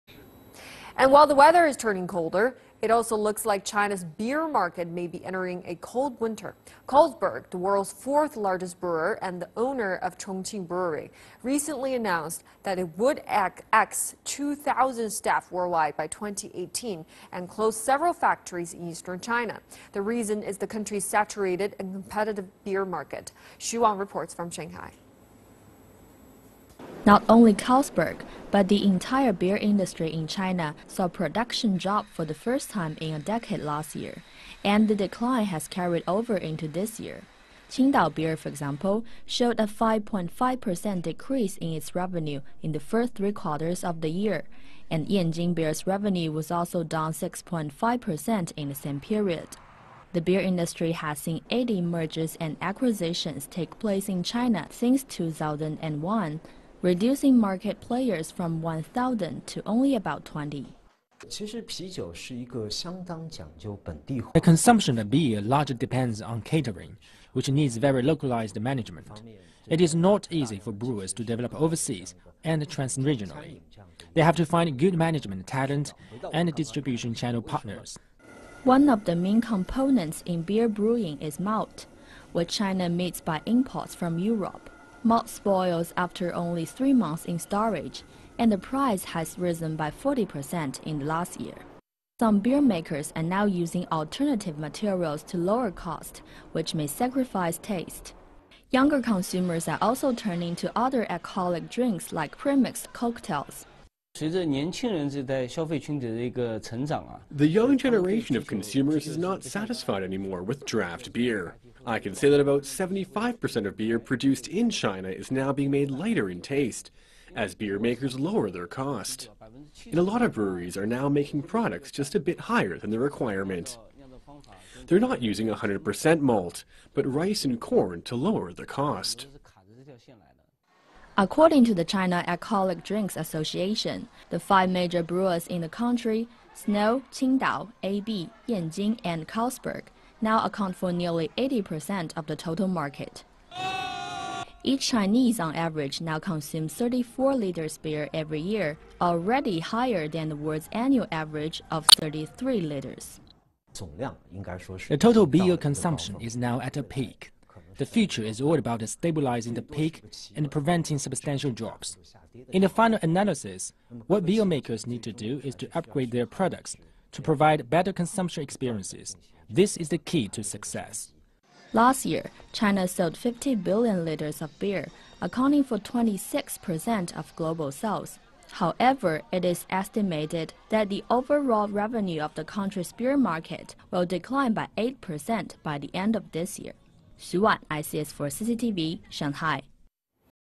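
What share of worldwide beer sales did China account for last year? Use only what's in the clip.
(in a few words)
26%.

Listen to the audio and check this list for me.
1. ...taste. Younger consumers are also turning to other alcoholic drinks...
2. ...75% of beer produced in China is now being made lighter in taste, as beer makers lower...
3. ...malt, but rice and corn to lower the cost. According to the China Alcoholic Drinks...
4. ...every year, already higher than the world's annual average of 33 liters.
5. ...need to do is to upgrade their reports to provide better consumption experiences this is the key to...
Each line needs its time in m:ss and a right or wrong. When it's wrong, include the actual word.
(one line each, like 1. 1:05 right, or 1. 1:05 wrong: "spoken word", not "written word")
1. 1:37 right
2. 1:52 right
3. 2:06 right
4. 2:28 right
5. 2:44 wrong: "products", not "reports".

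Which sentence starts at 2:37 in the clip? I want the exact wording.
The future is all about stabilizing the peak and preventing substantial drops.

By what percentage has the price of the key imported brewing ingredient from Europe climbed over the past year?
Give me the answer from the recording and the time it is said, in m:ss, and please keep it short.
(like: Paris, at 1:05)
40%, at 1:29.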